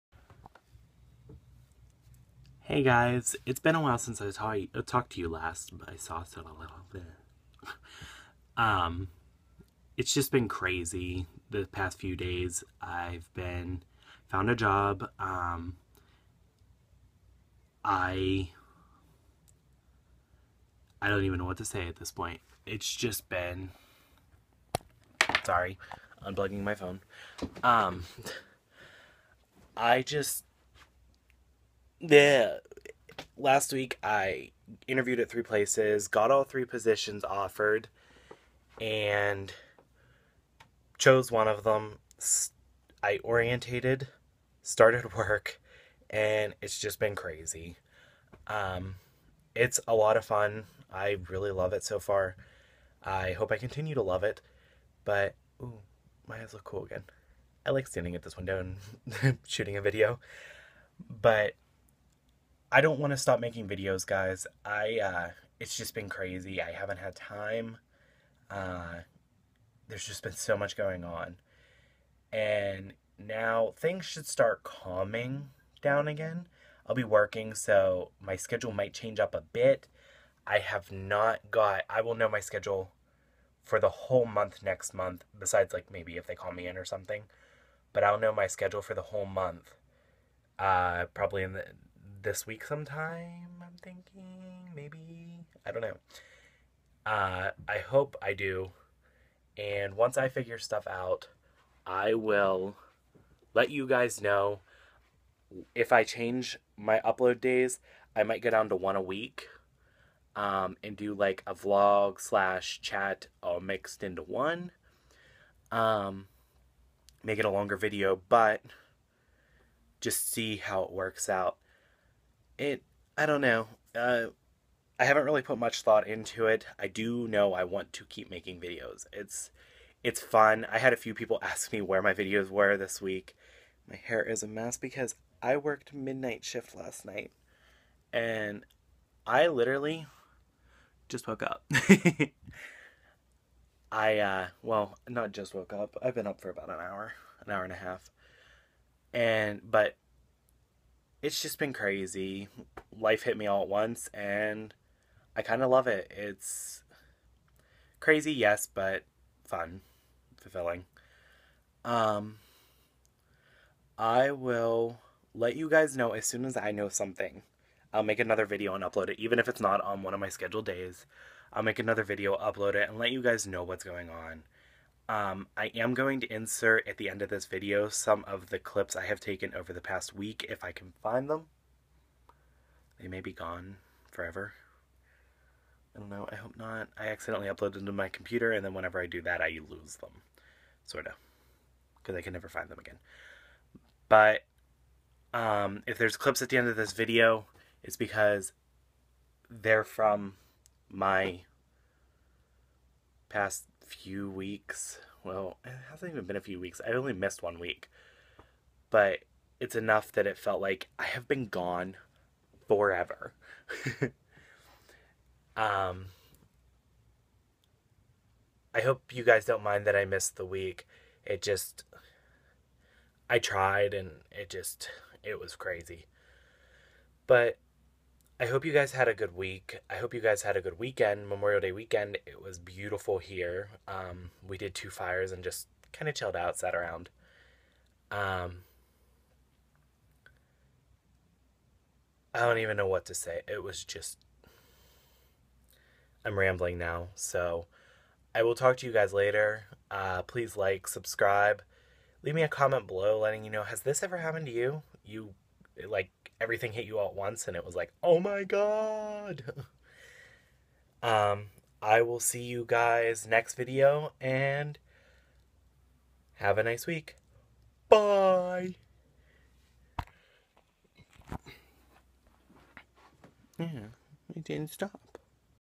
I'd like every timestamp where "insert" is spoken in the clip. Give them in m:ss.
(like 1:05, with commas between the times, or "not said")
2:56.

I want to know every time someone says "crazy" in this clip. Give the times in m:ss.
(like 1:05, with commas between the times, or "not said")
0:10, 0:47, 1:06, 2:31, 2:37, 3:45.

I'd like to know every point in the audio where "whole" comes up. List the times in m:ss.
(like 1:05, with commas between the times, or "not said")
1:23, 1:29.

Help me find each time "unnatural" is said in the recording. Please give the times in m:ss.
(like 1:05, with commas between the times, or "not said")
not said.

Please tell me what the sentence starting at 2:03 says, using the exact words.
Uh, I haven't really put much thought into it.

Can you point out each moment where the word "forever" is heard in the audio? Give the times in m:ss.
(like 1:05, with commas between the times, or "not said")
3:04, 3:32.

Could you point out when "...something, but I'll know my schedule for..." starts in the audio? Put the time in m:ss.
1:26.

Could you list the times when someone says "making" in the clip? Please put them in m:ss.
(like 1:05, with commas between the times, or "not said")
1:03, 2:08.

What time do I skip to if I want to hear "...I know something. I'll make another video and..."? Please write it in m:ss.
2:46.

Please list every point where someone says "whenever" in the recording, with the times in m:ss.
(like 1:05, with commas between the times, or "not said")
3:08.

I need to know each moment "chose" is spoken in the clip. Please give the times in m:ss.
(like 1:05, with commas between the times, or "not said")
0:40.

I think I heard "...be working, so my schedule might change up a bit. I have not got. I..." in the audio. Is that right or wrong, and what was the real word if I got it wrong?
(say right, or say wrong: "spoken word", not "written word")
right.